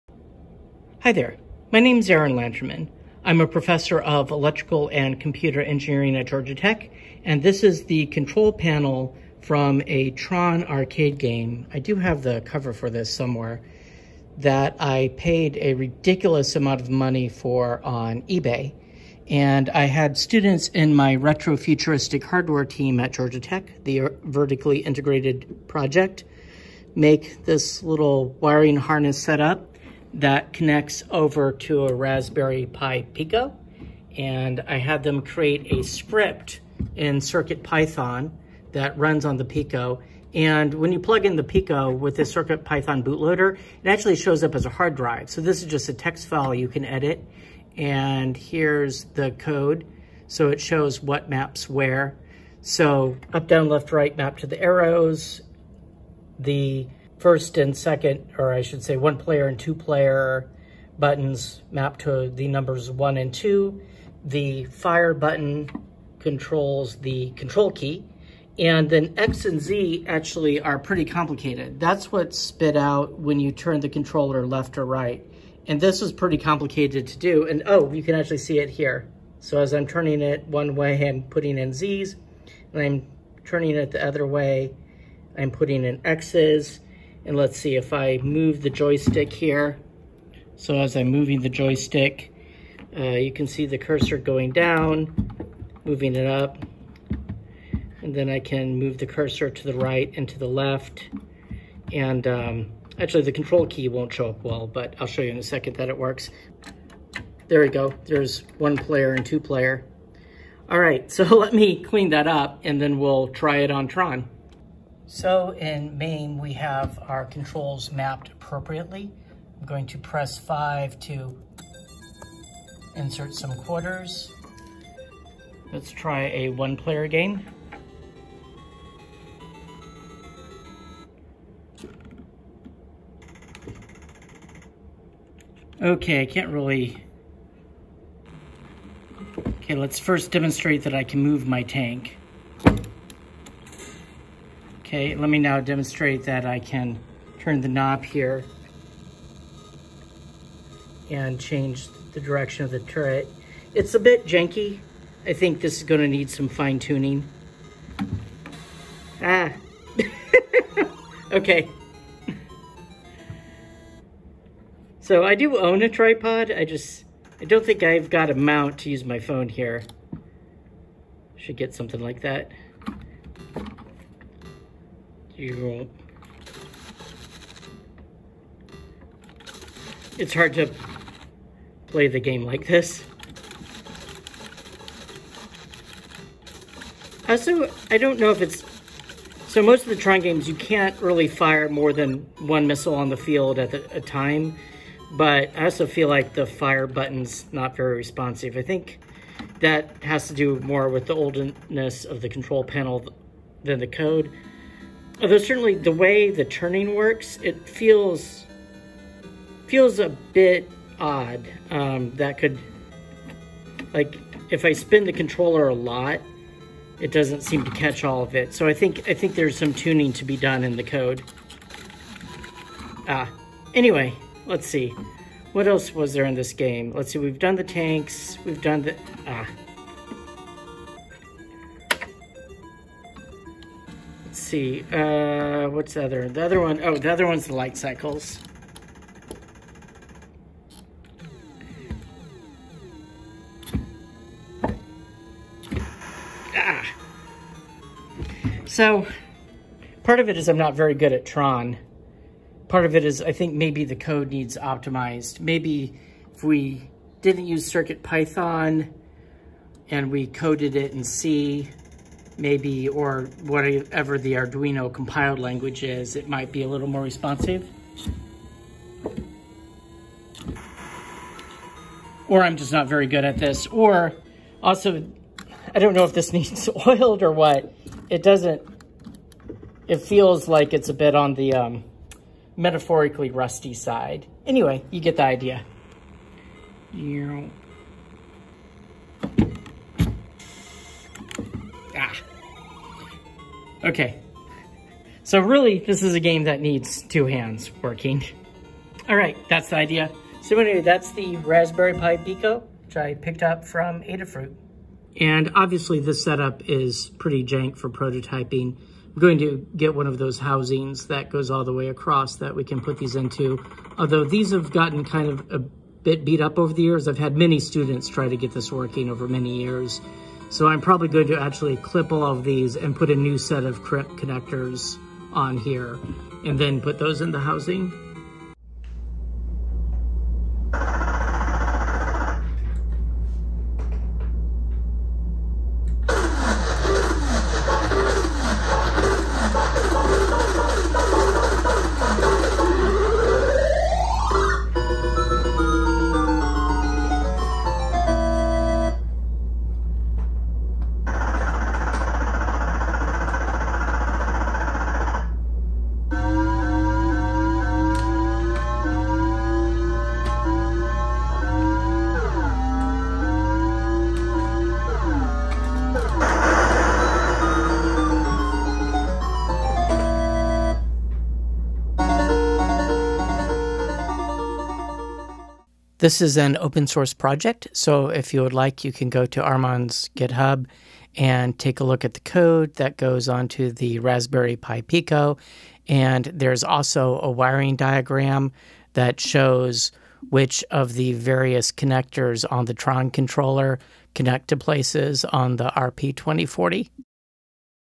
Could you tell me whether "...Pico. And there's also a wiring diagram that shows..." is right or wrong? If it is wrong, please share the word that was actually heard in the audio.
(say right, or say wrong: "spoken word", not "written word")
right.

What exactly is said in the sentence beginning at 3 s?
I'm a professor of electrical and computer engineering at Georgia Tech, and this is the control panel from a Tron arcade game.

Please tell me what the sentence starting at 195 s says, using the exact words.
But I also feel like the fire button's not very responsive.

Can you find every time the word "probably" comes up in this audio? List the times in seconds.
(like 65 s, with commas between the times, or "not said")
320 s.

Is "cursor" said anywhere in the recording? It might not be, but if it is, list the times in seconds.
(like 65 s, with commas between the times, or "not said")
93 s, 99 s.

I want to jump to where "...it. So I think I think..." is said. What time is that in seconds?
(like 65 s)
218 s.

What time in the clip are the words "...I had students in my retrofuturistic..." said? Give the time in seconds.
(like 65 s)
19 s.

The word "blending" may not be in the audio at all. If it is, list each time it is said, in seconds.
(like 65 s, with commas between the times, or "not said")
not said.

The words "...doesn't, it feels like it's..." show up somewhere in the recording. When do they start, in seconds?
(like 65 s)
278 s.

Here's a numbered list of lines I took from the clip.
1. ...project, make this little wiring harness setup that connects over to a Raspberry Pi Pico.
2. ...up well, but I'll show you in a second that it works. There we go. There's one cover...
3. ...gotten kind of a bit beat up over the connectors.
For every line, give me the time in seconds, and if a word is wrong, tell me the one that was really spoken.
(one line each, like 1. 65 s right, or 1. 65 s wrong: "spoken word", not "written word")
1. 25 s right
2. 104 s wrong: "player", not "cover"
3. 314 s wrong: "years", not "connectors".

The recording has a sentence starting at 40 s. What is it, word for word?
And when you plug in the Pico with the CircuitPython bootloader, it actually shows up as a hard drive.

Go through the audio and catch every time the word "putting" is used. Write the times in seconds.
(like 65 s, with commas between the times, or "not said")
81 s, 85 s.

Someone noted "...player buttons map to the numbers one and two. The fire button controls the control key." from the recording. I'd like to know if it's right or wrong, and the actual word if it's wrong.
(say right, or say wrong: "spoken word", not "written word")
right.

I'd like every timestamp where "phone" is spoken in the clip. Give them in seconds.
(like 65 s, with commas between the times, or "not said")
169 s.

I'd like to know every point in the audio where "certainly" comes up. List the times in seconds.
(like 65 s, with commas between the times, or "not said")
205 s.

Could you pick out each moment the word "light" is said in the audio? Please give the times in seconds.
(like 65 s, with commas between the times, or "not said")
237 s.